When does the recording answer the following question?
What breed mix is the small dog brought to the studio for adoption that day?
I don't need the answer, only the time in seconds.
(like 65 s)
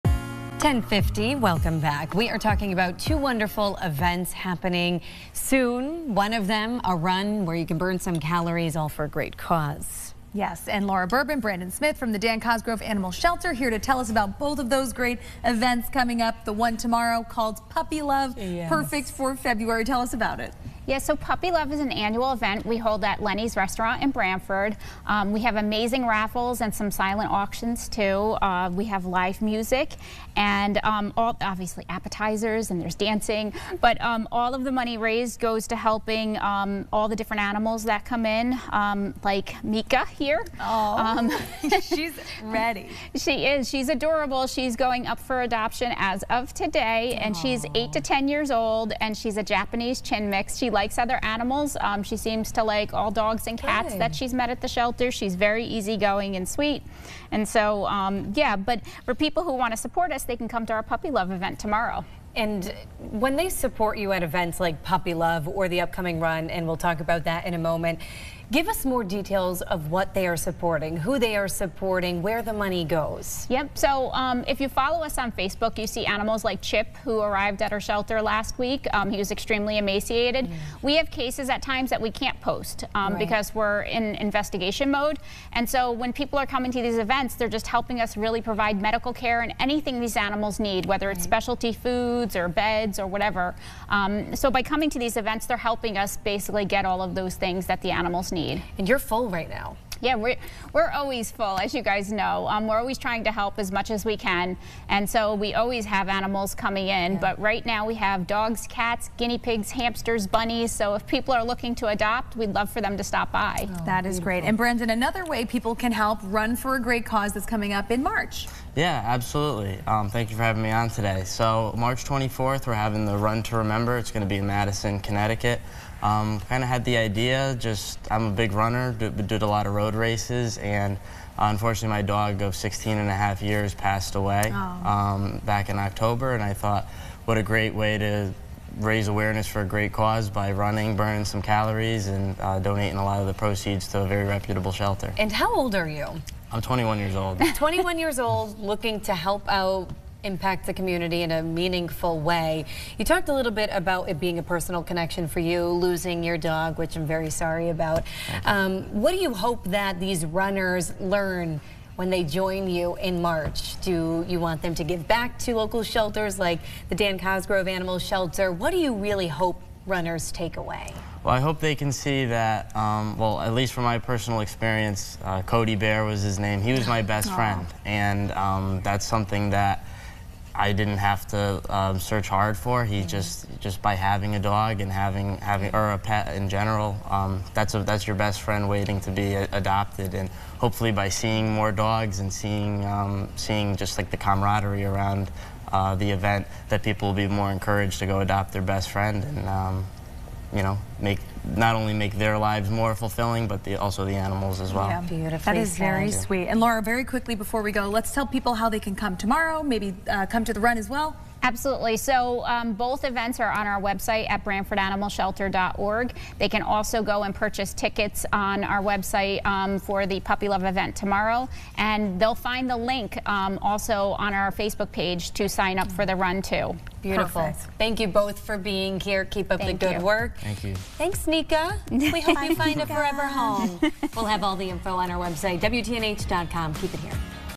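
49 s.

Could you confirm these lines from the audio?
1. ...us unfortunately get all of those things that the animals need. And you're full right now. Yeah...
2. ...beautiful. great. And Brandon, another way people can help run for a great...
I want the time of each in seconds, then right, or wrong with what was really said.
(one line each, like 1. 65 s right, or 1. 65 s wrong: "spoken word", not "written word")
1. 95 s wrong: "basically", not "unfortunately"
2. 114 s right.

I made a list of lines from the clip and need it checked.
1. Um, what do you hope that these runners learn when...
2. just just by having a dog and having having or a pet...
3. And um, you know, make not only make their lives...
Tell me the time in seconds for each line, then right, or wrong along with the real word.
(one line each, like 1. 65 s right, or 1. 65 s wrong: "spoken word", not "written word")
1. 158 s right
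2. 183 s right
3. 199 s right.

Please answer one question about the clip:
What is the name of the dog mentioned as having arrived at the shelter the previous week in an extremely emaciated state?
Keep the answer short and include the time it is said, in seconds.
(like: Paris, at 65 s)
Chip, at 76 s.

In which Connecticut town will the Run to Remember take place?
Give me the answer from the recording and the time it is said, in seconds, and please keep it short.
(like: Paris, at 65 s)
Madison, at 124 s.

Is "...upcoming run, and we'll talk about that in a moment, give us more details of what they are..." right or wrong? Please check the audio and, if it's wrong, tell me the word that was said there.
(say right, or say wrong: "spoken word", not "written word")
right.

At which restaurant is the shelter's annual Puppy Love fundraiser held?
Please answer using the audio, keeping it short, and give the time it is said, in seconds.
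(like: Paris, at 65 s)
Lenny's Restaurant, at 23 s.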